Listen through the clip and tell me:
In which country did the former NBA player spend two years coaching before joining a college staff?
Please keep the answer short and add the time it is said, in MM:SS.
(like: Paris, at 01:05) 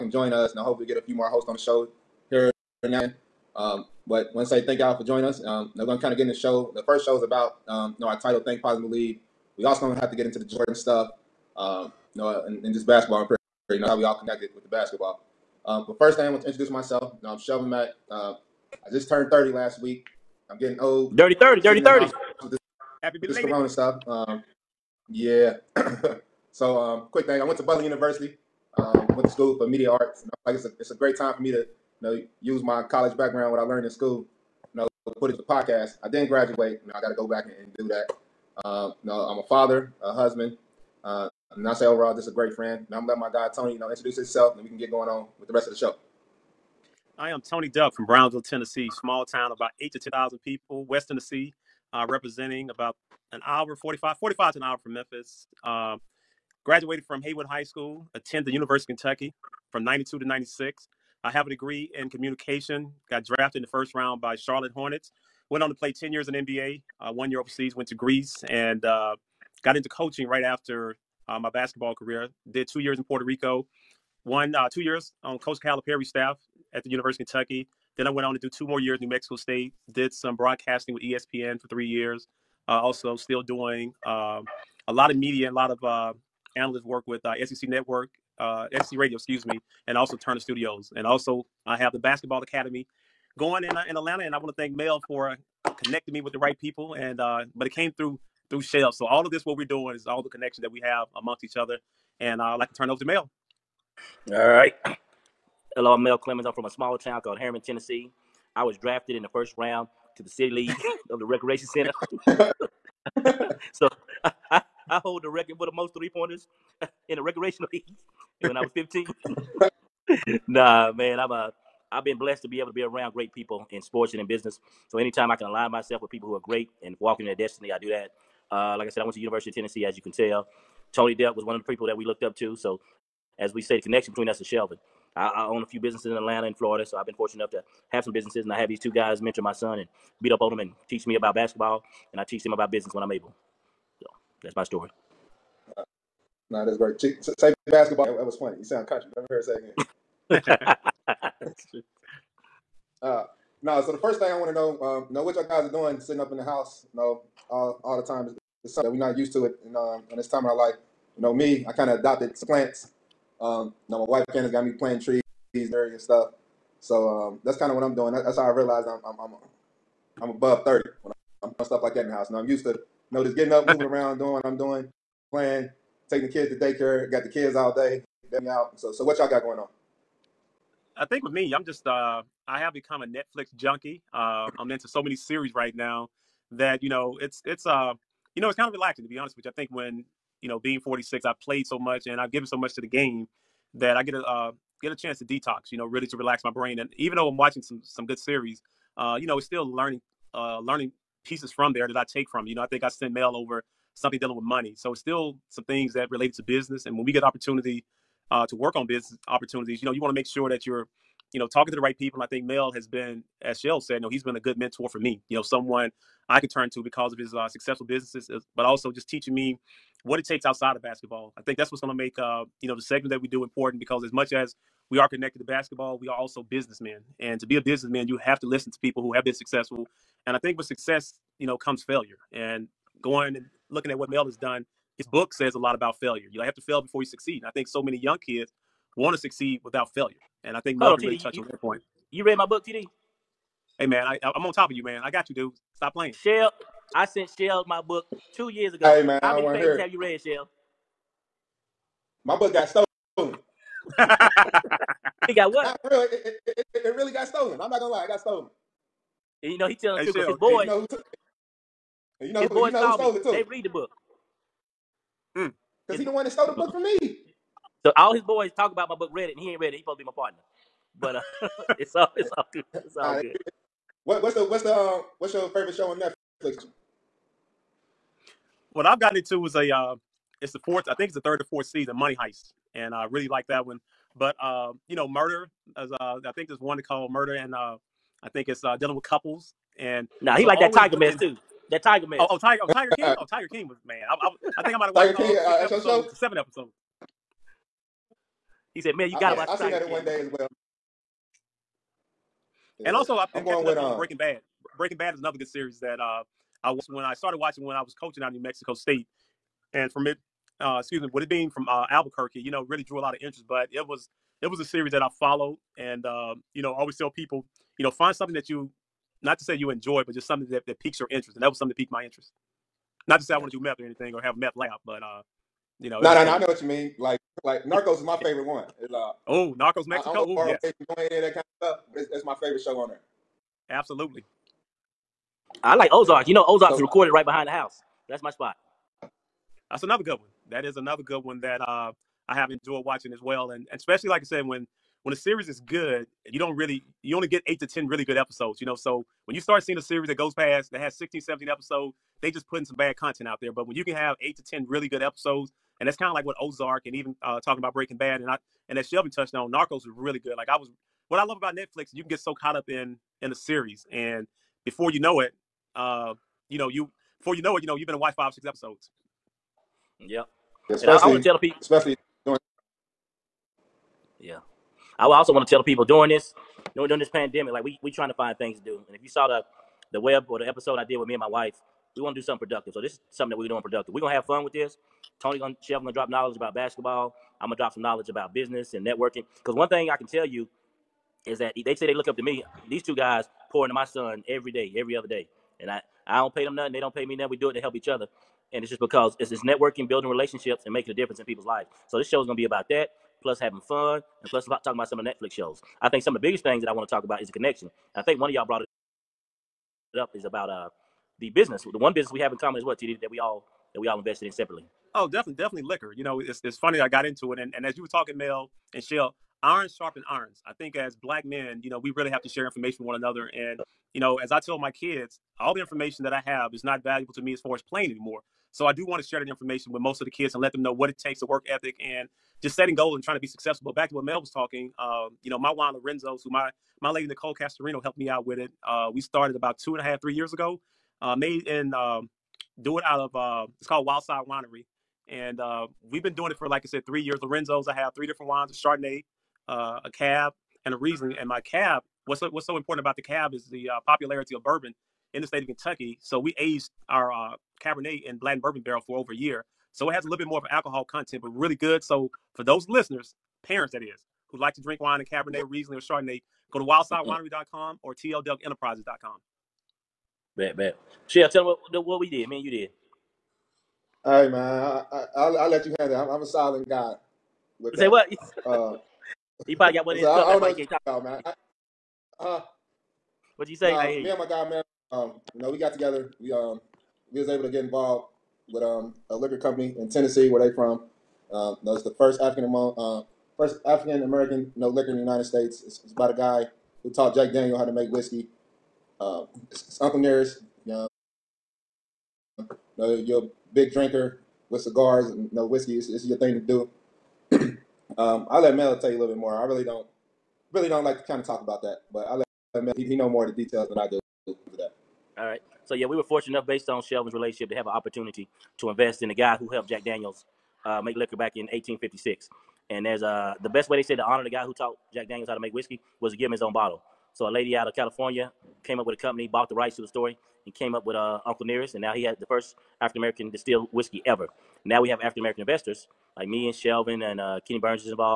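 Puerto Rico, at 01:13.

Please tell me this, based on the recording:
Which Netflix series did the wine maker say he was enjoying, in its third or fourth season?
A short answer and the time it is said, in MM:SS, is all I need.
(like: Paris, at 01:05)
Money Heist, at 04:41.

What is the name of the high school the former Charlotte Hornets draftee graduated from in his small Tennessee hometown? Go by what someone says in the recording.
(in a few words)
Haywood High School.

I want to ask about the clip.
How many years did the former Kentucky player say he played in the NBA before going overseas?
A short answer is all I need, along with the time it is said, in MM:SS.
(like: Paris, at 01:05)
10, at 01:05.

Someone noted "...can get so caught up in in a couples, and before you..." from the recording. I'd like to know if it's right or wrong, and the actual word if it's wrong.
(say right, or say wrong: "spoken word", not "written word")
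wrong: "series", not "couples".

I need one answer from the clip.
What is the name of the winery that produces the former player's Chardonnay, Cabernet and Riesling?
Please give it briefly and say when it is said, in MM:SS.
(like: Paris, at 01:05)
Wildside Winery, at 07:23.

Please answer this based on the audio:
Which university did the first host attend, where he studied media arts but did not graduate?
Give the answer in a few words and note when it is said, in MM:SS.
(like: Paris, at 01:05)
Butler University, at 00:27.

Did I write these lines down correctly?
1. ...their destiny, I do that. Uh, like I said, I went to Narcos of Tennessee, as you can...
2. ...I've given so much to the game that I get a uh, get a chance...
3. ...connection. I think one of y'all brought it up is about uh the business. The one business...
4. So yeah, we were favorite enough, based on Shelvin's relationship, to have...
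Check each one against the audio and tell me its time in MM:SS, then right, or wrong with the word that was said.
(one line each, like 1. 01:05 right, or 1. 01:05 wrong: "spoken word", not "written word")
1. 02:07 wrong: "University", not "Narcos"
2. 03:12 right
3. 06:47 right
4. 08:35 wrong: "fortunate", not "favorite".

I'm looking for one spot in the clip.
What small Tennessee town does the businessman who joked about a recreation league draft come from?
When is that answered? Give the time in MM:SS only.
01:47.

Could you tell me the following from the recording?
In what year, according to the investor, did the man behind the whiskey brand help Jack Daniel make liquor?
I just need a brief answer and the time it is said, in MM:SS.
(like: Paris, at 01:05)
1856, at 08:41.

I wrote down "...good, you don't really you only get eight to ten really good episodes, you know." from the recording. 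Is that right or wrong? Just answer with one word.
right.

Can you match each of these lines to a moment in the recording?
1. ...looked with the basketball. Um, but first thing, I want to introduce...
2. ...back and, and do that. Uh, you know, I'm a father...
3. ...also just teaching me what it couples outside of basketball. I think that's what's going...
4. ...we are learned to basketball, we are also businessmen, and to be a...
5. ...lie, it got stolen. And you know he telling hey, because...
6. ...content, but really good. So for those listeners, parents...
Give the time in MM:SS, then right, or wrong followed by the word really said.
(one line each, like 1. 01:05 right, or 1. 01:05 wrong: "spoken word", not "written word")
1. 00:14 wrong: "connected", not "looked"
2. 00:37 right
3. 03:38 wrong: "takes", not "couples"
4. 03:44 wrong: "connected", not "learned"
5. 04:17 right
6. 07:40 right.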